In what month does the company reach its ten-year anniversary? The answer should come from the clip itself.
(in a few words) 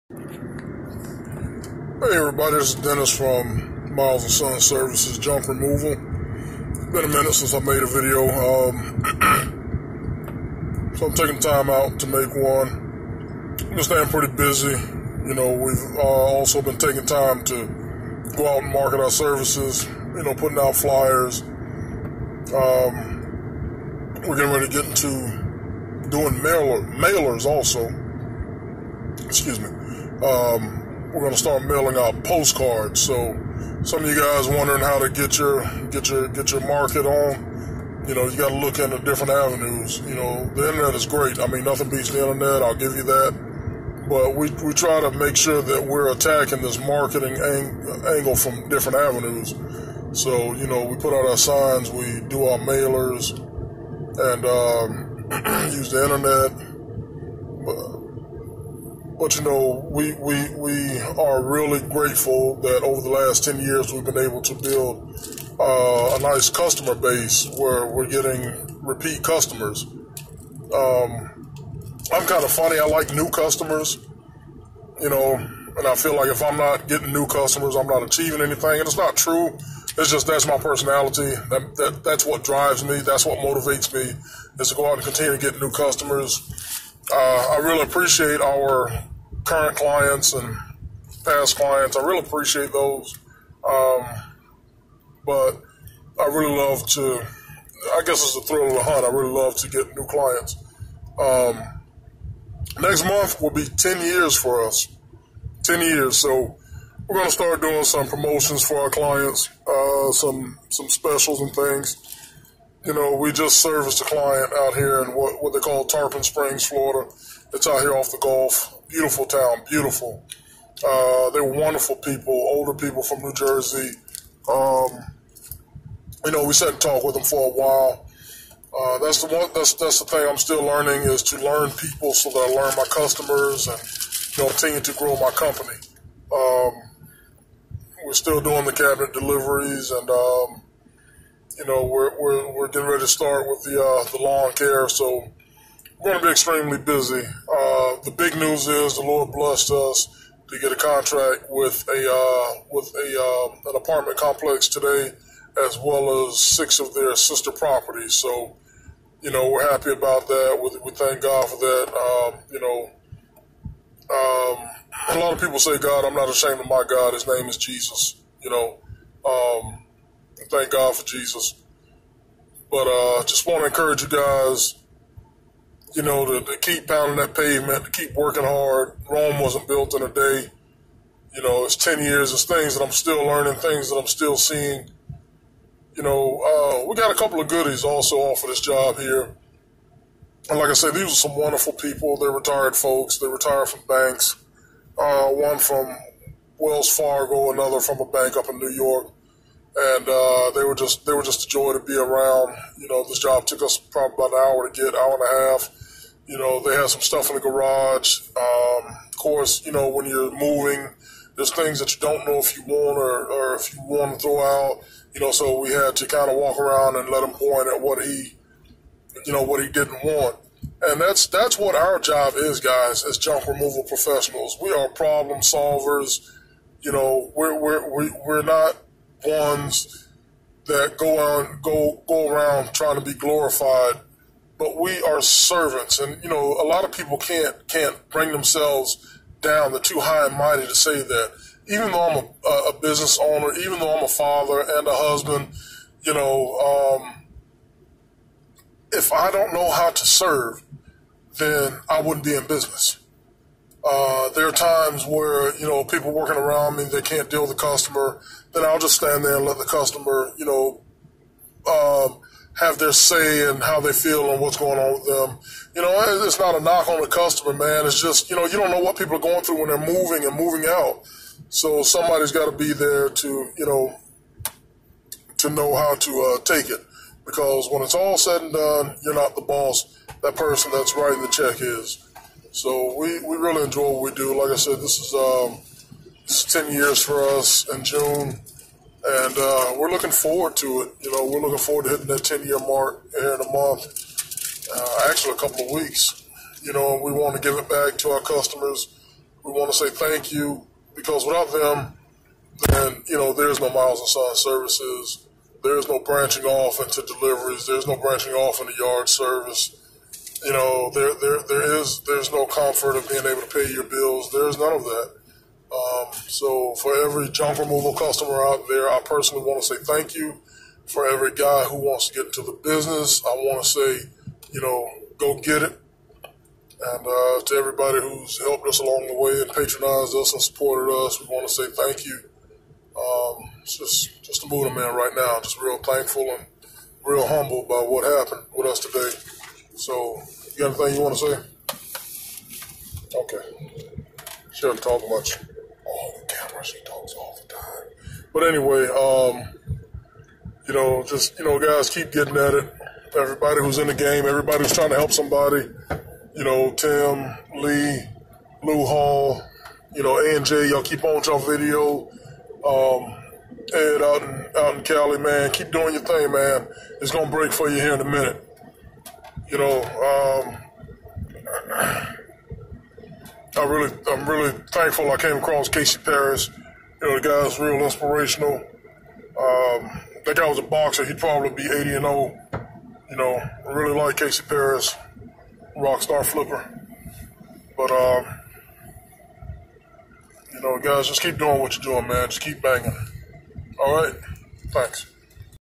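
June.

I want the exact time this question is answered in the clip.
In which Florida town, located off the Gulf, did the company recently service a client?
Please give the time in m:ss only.
1:55.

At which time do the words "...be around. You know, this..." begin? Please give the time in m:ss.
3:21.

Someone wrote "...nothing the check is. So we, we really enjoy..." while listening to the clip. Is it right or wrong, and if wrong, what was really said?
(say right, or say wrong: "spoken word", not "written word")
wrong: "writing", not "nothing".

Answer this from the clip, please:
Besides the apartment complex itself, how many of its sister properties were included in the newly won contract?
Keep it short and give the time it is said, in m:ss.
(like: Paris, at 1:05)
6, at 2:36.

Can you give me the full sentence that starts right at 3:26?
You know, they had some stuff in the garage.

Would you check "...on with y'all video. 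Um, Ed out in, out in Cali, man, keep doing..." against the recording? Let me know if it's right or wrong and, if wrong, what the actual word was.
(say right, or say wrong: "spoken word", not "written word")
right.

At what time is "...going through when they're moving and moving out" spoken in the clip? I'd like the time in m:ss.
4:29.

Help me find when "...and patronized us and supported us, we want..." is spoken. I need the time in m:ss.
5:29.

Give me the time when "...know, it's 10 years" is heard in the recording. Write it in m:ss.
3:01.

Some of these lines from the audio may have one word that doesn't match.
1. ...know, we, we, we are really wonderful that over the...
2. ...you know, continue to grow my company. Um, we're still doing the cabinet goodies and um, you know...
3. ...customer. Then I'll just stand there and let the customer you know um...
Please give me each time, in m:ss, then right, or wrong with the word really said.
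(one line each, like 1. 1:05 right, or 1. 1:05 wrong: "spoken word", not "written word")
1. 0:59 wrong: "grateful", not "wonderful"
2. 2:14 wrong: "deliveries", not "goodies"
3. 4:17 right.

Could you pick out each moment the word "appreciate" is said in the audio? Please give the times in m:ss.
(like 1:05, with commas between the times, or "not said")
1:27, 1:32.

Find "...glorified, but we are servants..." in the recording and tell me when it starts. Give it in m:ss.
3:53.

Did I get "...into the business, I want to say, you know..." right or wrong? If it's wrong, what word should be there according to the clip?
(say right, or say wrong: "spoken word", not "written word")
right.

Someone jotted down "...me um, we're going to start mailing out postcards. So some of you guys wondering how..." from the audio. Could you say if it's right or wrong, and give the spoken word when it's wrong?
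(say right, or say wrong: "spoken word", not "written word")
right.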